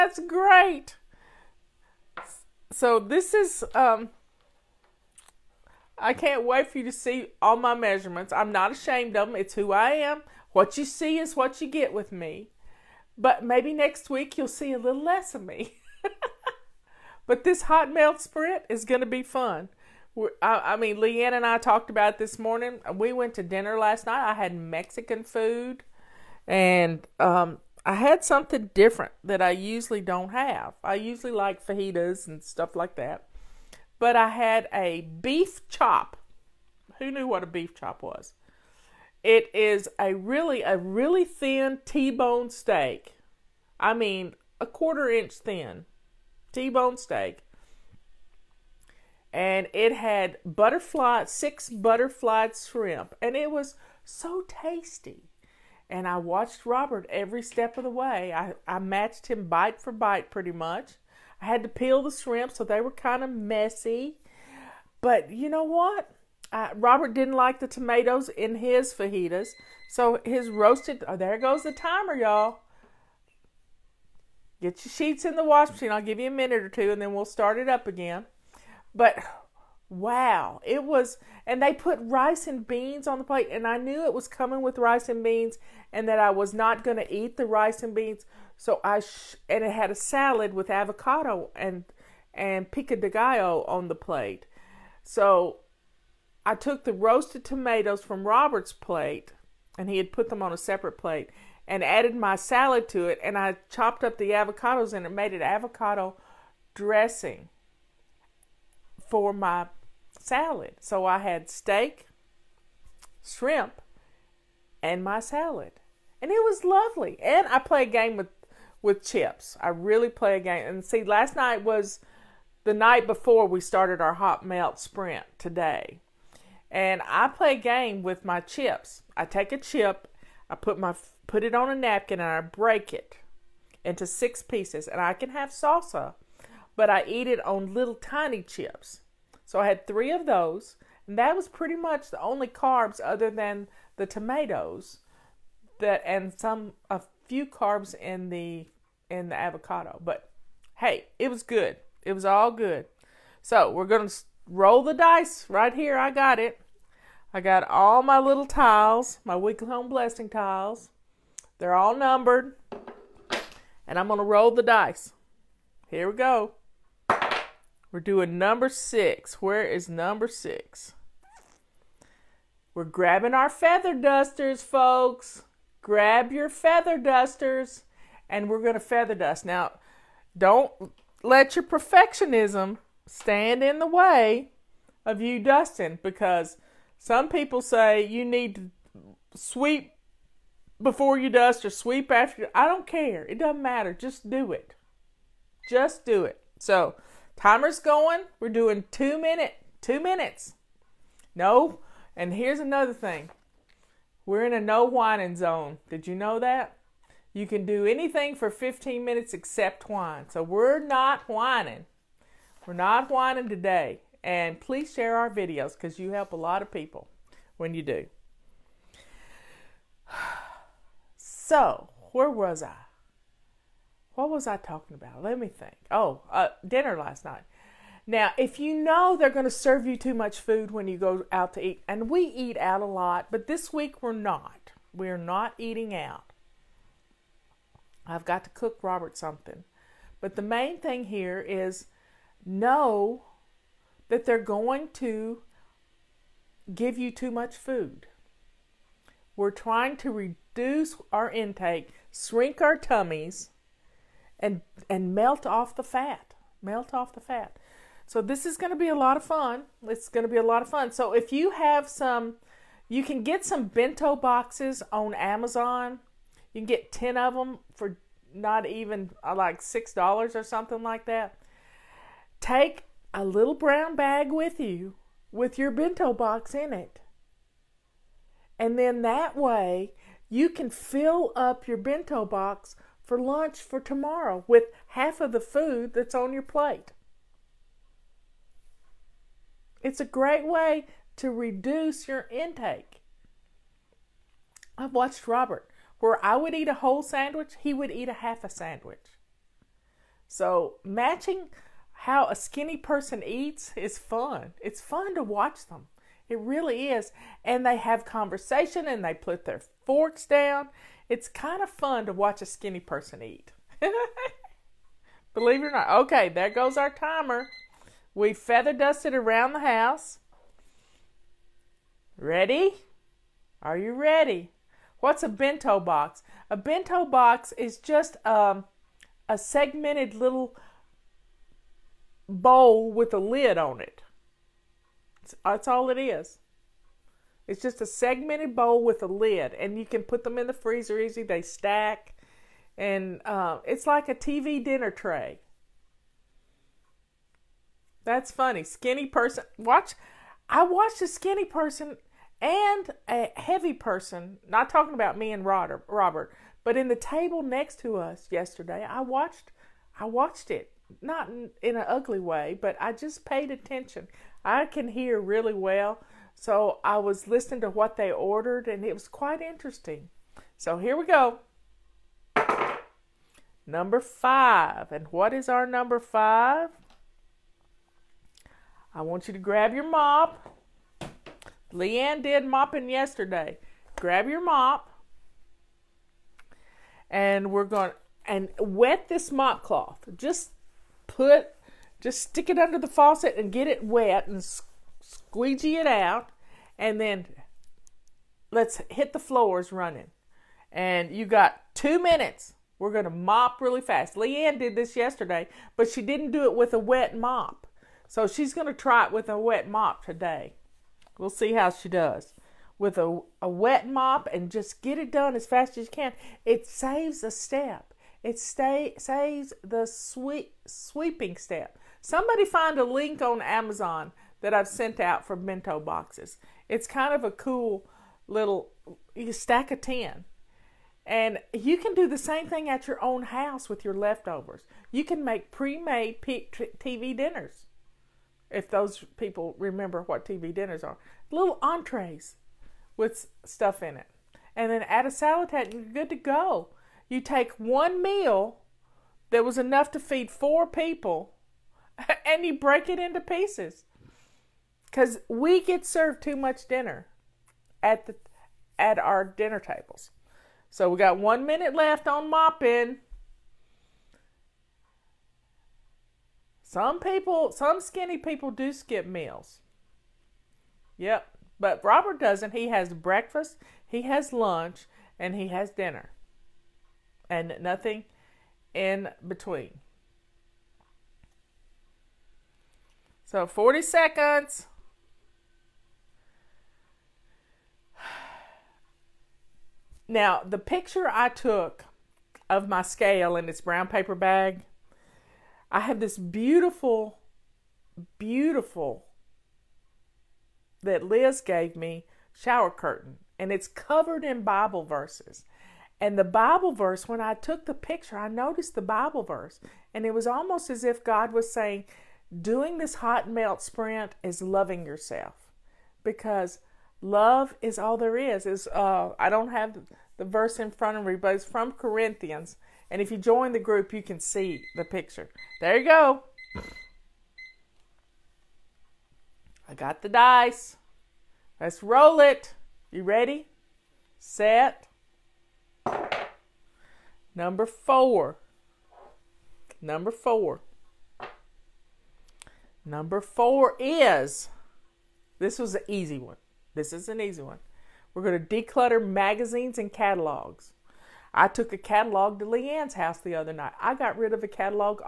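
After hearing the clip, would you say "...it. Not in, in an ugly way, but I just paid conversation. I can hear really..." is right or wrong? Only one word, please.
wrong.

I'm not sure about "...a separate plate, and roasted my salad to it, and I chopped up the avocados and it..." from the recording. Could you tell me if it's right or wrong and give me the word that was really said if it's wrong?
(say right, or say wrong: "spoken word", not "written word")
wrong: "added", not "roasted".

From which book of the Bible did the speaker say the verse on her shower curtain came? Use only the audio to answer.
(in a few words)
Corinthians.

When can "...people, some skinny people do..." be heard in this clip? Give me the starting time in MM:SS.
07:46.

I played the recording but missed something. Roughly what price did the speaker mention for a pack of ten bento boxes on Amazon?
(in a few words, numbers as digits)
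$6.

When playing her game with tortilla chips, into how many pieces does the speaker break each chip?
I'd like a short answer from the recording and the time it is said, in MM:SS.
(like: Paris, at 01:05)
6, at 02:14.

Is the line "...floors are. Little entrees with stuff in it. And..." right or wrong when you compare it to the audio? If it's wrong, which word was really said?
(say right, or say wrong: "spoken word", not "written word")
wrong: "dinners", not "floors".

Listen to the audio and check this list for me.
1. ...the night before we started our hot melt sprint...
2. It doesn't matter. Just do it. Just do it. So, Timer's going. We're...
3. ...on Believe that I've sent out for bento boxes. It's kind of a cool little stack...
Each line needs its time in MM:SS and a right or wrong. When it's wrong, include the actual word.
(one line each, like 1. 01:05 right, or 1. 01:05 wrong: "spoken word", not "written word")
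1. 02:02 right
2. 03:13 right
3. 07:03 wrong: "Amazon", not "Believe".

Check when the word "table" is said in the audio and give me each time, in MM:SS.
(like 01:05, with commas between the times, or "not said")
05:56, 07:39.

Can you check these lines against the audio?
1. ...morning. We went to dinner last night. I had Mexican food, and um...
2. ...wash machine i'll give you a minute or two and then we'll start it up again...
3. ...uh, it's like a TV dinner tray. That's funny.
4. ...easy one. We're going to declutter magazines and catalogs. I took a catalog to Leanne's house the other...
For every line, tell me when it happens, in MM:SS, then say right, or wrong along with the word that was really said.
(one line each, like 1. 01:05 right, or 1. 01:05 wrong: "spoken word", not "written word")
1. 00:22 right
2. 01:15 right
3. 05:43 right
4. 09:07 right.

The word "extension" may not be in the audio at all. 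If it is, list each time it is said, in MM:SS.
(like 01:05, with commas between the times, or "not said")
not said.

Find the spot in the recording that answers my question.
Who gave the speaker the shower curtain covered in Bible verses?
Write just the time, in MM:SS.
08:21.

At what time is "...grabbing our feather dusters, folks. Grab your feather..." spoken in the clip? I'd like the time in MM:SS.
02:52.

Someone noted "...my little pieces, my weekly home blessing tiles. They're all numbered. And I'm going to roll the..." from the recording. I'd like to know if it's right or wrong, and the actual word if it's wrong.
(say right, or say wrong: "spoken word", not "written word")
wrong: "tiles", not "pieces".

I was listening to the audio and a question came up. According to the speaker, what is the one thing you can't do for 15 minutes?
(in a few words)
whine.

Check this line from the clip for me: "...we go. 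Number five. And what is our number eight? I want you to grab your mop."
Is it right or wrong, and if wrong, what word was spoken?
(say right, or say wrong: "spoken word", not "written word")
wrong: "five", not "eight".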